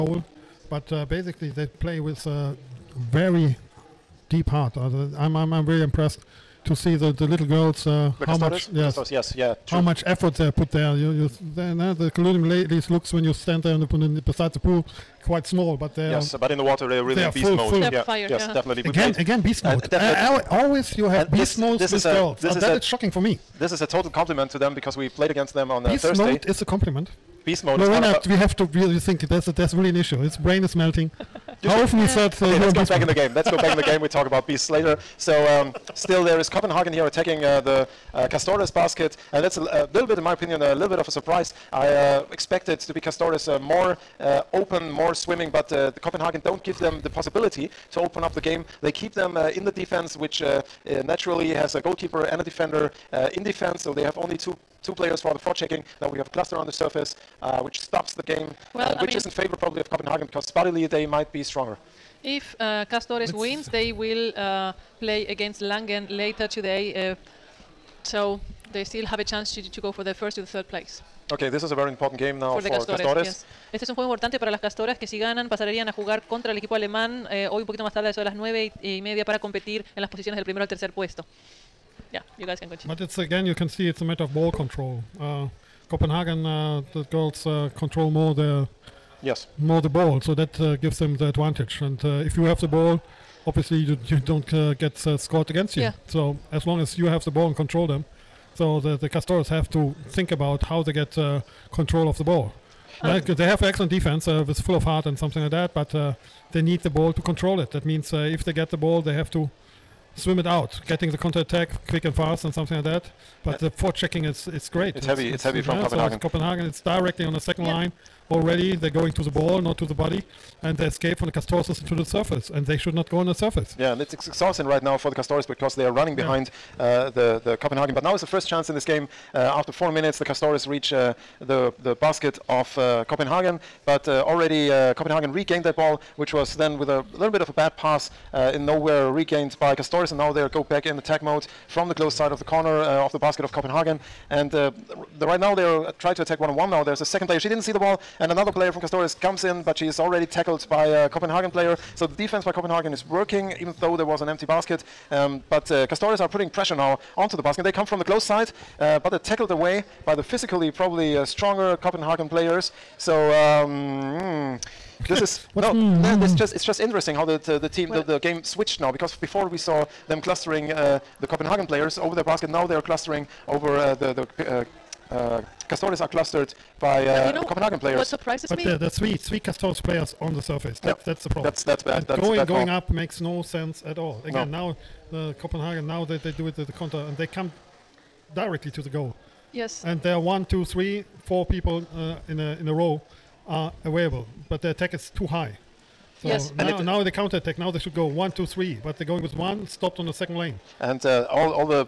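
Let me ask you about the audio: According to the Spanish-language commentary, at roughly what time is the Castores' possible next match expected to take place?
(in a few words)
9:30.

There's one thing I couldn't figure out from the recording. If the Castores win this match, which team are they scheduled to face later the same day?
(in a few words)
Langen.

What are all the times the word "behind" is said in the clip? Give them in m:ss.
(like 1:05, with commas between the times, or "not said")
2:06.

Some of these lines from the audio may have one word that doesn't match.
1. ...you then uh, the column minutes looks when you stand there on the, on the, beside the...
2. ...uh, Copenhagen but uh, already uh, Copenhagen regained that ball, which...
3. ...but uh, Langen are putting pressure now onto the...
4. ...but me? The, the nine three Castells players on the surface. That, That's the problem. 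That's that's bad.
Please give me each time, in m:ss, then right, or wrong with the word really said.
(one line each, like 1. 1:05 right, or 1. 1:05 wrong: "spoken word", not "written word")
1. 0:11 wrong: "ladies", not "minutes"
2. 2:12 right
3. 2:35 wrong: "Castores", not "Langen"
4. 2:58 wrong: "three", not "nine".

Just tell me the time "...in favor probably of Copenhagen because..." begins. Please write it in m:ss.
0:59.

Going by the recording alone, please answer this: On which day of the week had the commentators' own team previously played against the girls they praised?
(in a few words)
Thursday.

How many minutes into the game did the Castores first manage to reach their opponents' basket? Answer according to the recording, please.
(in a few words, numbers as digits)
4.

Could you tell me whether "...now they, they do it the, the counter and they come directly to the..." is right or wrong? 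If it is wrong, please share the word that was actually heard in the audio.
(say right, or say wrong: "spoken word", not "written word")
right.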